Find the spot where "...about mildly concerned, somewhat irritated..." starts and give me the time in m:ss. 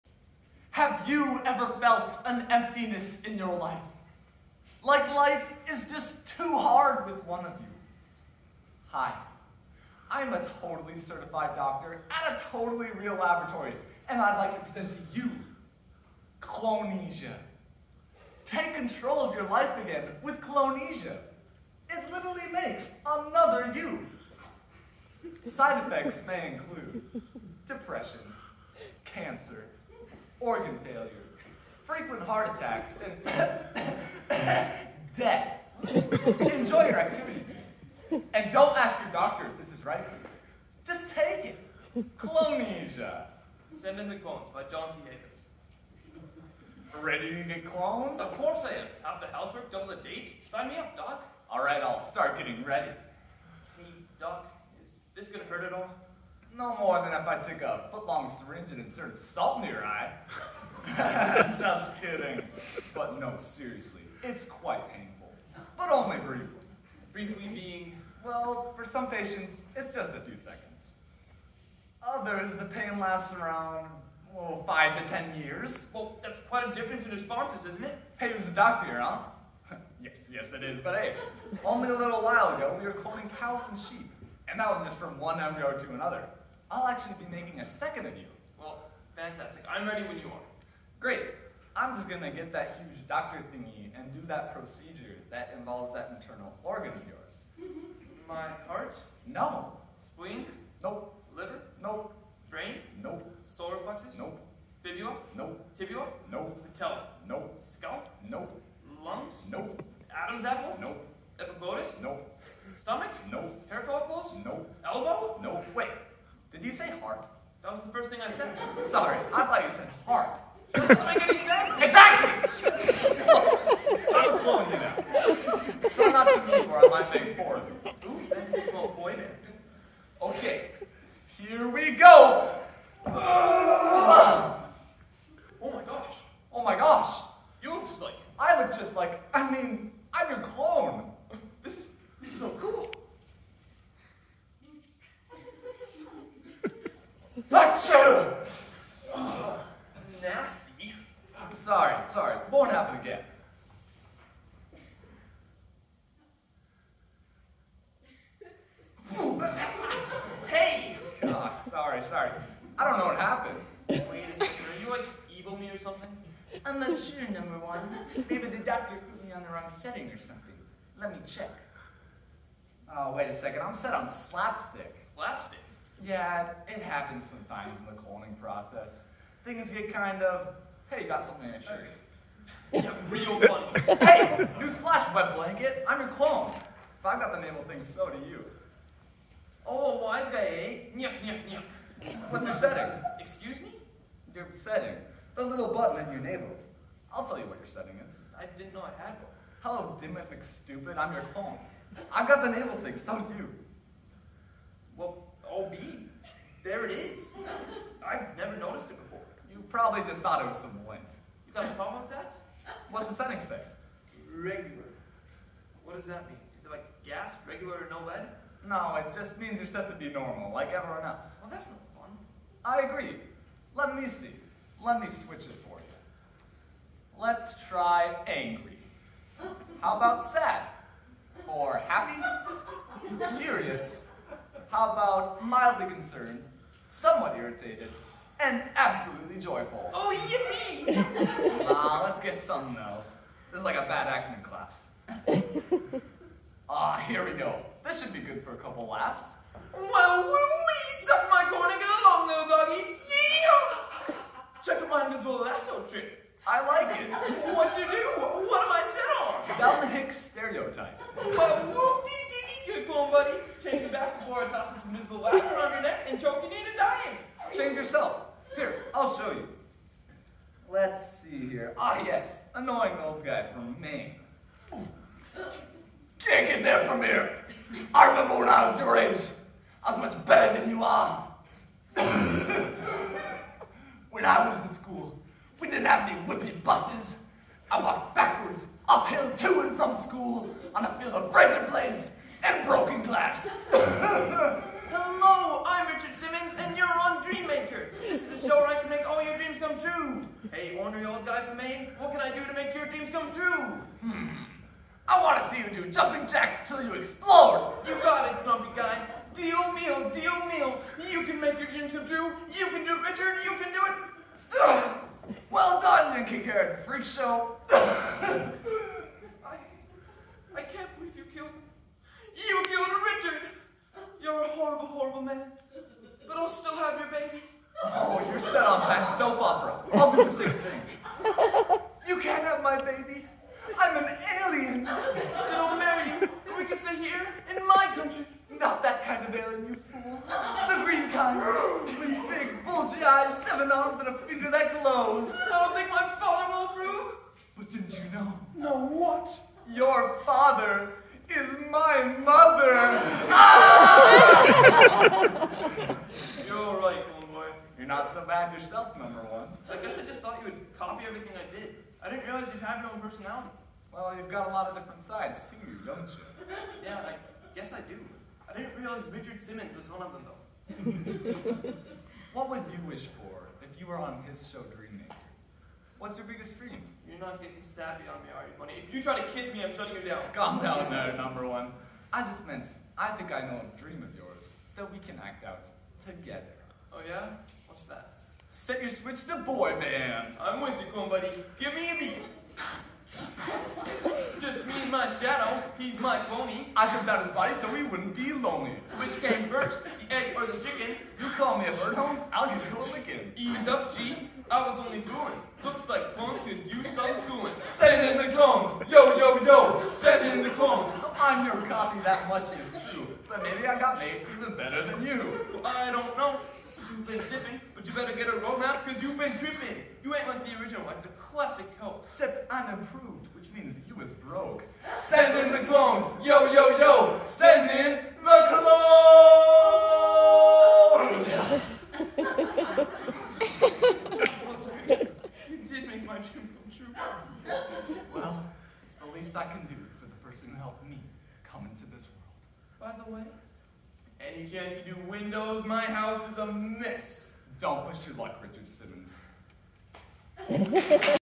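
3:54.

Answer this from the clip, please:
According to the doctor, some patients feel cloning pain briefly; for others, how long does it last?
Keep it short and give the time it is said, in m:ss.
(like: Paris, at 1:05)
5 to 10 years, at 1:14.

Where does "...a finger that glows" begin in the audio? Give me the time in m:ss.
5:44.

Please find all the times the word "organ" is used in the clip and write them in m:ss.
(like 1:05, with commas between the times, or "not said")
0:30, 1:36.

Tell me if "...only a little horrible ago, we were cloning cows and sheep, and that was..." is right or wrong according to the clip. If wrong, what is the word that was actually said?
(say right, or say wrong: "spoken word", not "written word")
wrong: "while", not "horrible".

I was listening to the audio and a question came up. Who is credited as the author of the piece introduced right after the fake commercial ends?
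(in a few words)
John C. Havens.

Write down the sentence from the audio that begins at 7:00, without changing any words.
You ain't like the original, like the classic Coke.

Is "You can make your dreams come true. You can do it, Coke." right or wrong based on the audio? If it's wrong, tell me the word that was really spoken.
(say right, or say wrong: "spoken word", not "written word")
wrong: "Richard", not "Coke".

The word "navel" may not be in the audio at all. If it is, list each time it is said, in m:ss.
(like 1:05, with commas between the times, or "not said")
3:16, 3:22.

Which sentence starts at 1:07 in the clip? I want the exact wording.
Briefly being, well, for some patients, it's just a few seconds.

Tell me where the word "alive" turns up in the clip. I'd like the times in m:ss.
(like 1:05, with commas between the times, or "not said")
not said.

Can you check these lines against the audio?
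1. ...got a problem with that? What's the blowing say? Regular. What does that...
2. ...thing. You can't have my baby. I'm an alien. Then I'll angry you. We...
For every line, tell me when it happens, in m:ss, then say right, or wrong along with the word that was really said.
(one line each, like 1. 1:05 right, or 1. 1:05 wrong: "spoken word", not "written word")
1. 3:31 wrong: "setting", not "blowing"
2. 5:30 wrong: "marry", not "angry".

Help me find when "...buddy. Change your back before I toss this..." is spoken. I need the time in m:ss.
4:23.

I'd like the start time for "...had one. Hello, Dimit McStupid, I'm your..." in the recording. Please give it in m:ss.
3:19.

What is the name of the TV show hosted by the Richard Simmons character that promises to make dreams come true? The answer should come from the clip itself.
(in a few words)
Dreammaker.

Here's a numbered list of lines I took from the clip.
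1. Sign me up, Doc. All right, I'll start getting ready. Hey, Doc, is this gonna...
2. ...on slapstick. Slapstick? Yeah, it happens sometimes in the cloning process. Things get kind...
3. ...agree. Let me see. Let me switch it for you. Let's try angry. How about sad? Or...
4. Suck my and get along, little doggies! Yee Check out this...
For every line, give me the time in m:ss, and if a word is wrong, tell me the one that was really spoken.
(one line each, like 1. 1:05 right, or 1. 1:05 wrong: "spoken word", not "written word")
1. 0:50 right
2. 2:53 right
3. 3:42 right
4. 4:11 right.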